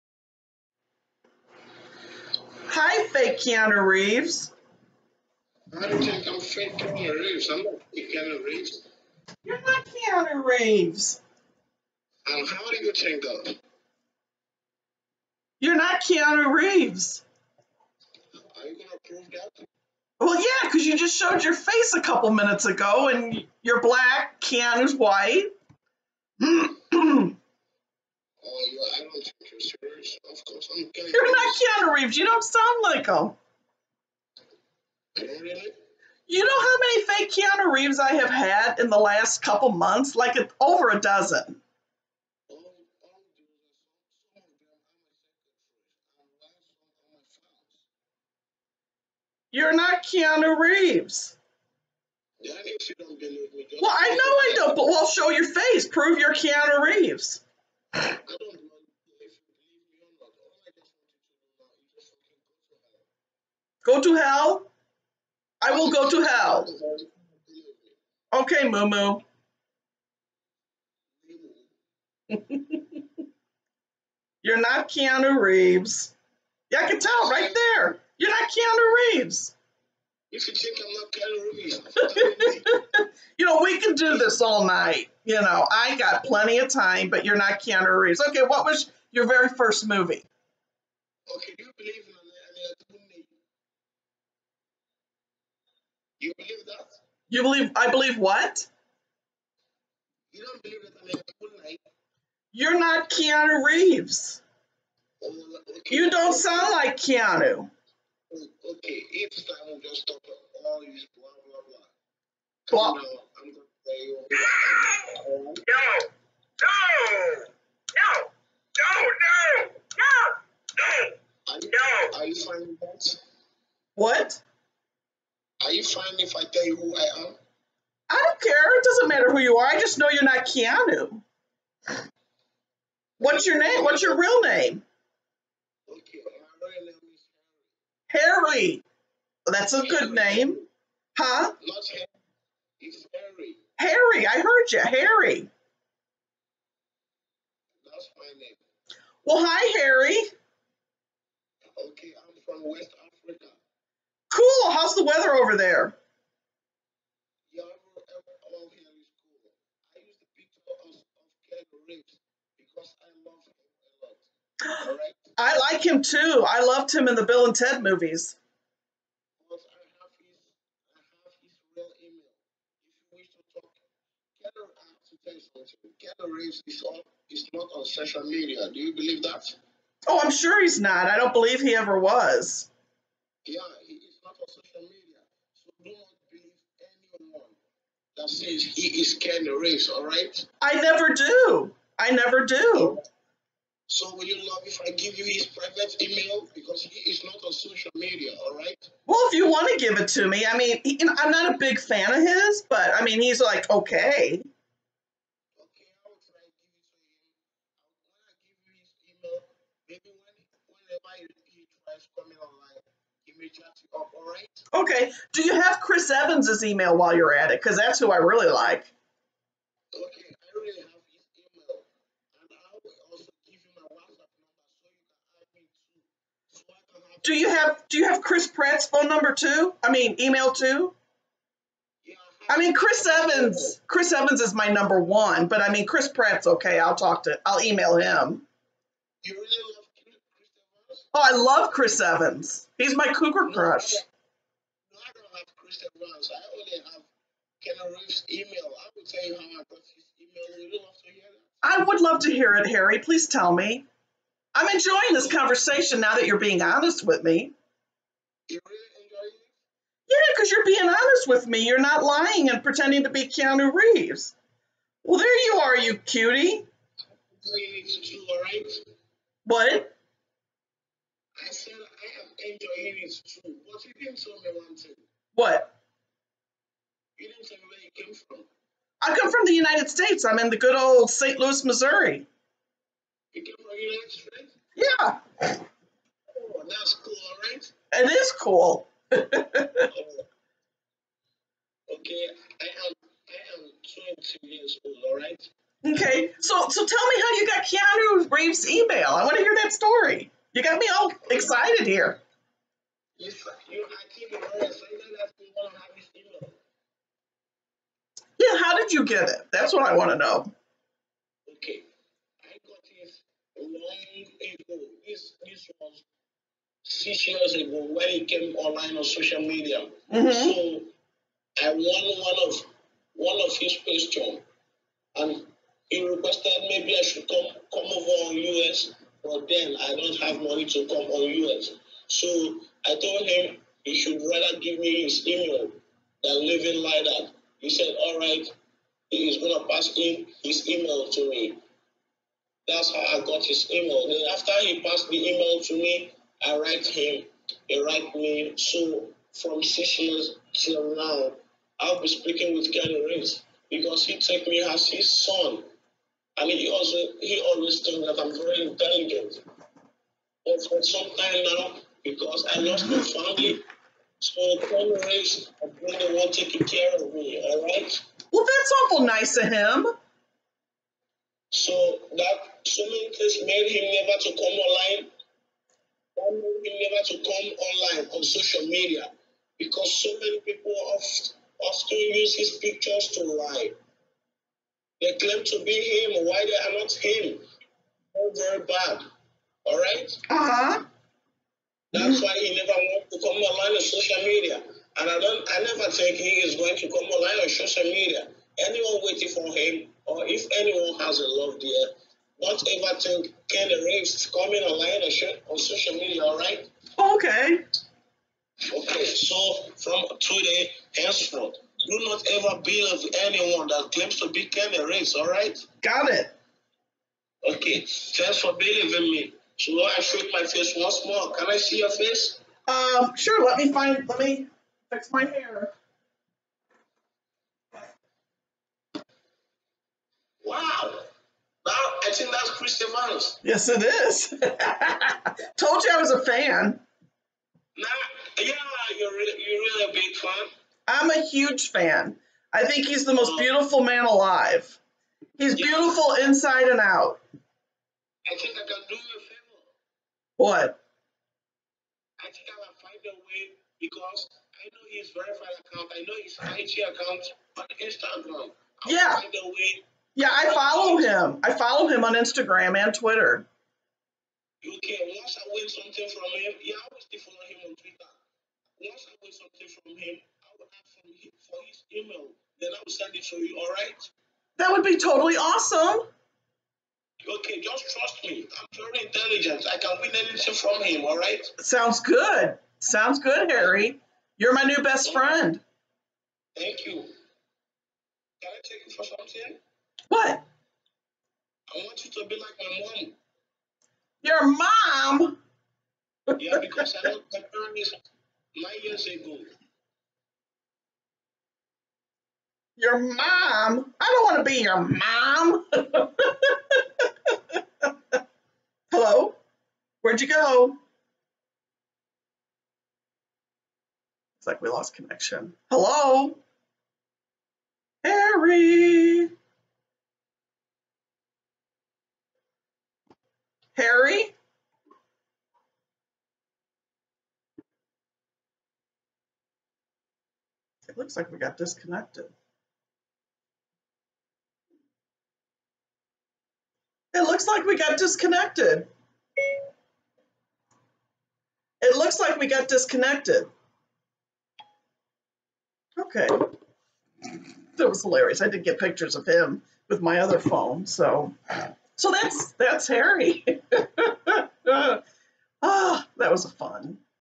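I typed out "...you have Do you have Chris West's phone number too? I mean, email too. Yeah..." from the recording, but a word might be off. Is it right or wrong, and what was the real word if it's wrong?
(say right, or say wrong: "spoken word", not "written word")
wrong: "Pratt", not "West".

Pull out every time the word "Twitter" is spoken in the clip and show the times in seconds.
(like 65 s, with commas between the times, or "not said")
462 s, 467 s.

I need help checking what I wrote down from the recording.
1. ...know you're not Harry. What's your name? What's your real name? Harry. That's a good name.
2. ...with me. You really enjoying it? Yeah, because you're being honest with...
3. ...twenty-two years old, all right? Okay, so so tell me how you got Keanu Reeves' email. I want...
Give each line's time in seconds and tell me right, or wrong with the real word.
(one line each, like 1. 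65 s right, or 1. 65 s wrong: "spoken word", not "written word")
1. 129 s wrong: "Keanu", not "Harry"
2. 257 s right
3. 293 s right.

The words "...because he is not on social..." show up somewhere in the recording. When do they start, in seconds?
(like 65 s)
196 s.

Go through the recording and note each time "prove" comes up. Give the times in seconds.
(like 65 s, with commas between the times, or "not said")
19 s, 55 s.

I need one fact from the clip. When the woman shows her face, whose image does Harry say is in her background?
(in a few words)
Christian Miles.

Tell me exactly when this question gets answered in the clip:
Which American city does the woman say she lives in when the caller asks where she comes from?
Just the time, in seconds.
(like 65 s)
281 s.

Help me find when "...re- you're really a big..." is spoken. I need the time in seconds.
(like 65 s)
439 s.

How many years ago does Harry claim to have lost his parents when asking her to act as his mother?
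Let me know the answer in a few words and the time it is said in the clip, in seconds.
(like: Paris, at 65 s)
9, at 498 s.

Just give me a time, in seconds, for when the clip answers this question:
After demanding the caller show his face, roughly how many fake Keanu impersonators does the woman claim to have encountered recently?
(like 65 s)
40 s.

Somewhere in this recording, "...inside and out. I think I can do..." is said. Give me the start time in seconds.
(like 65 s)
446 s.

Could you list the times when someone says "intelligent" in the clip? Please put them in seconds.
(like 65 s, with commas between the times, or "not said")
358 s, 479 s.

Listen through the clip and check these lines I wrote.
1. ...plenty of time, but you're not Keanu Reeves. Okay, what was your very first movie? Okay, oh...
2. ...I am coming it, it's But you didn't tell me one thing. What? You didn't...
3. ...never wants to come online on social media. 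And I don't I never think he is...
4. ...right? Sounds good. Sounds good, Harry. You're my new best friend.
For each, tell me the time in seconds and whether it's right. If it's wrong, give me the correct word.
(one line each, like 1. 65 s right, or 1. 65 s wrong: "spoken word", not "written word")
1. 86 s right
2. 271 s wrong: "enjoying", not "coming"
3. 392 s right
4. 481 s right.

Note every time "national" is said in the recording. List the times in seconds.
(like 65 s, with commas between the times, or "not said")
not said.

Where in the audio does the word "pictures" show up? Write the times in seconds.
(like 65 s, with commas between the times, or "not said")
382 s, 548 s.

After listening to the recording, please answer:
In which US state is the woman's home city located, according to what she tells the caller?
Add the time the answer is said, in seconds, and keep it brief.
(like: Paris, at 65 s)
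Missouri, at 281 s.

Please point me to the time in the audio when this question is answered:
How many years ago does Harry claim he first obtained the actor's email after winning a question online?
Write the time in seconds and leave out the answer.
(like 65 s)
316 s.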